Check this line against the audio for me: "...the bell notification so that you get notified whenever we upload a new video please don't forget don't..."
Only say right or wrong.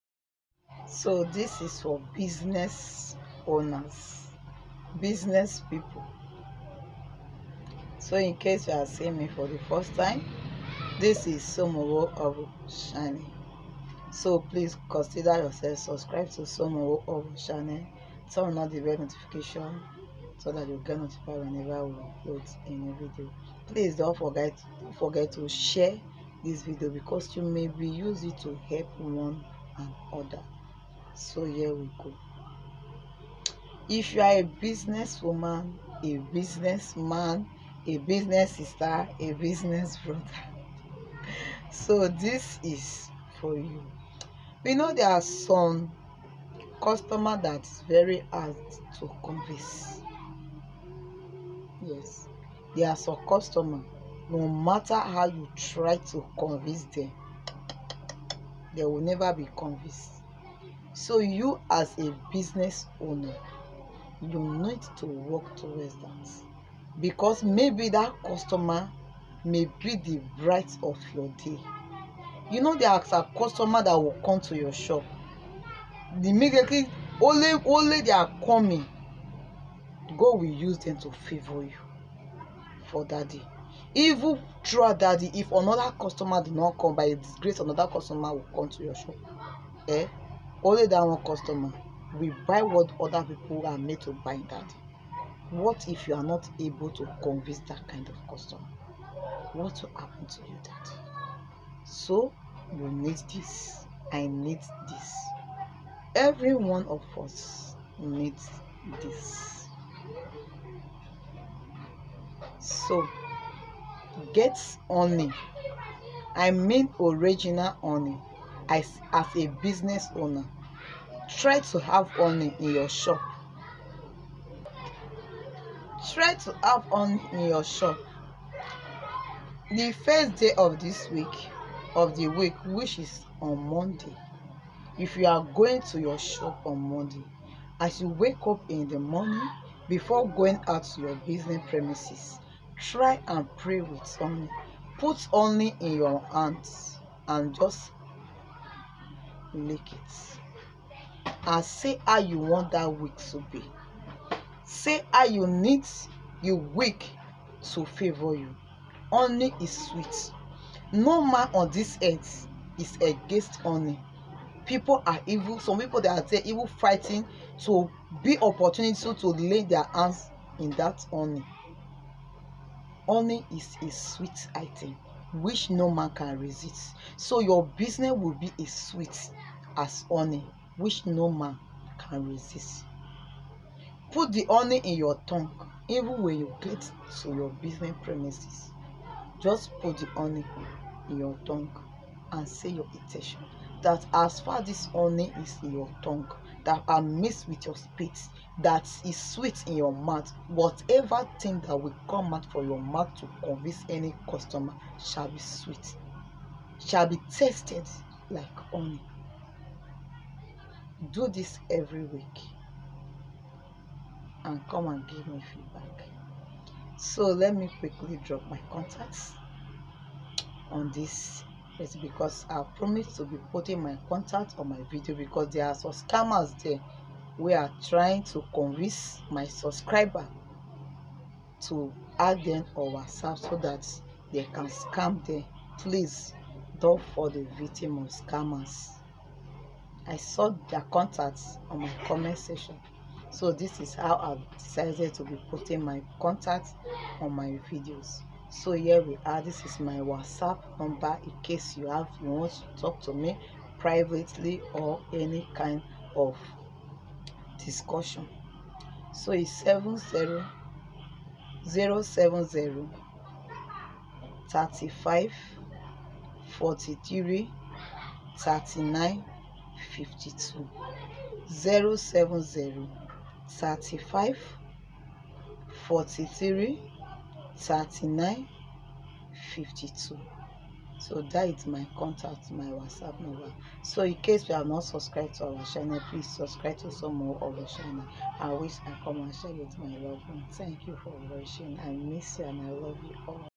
right.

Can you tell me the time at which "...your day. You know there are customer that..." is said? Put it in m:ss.
1:11.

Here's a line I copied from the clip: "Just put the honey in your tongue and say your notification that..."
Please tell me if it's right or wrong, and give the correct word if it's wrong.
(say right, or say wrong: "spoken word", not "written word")
wrong: "intention", not "notification".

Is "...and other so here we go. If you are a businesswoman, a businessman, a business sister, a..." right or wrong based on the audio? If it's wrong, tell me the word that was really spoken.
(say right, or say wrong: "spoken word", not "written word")
right.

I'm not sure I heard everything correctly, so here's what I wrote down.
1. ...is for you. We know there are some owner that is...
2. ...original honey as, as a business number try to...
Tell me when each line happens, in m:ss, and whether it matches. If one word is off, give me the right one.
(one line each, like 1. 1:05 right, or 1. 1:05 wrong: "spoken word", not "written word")
1. 0:42 wrong: "customer", not "owner"
2. 1:56 wrong: "owner", not "number".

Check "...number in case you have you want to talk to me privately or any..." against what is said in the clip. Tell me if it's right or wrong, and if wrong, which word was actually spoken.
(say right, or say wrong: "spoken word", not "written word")
right.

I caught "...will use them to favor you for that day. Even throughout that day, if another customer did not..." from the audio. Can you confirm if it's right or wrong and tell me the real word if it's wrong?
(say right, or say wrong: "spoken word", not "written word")
right.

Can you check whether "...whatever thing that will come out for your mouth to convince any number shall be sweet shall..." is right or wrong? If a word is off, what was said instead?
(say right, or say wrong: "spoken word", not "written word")
wrong: "customer", not "number".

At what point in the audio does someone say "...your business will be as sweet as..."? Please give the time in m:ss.
2:57.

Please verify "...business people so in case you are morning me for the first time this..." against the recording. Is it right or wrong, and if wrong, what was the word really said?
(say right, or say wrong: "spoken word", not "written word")
wrong: "seeing", not "morning".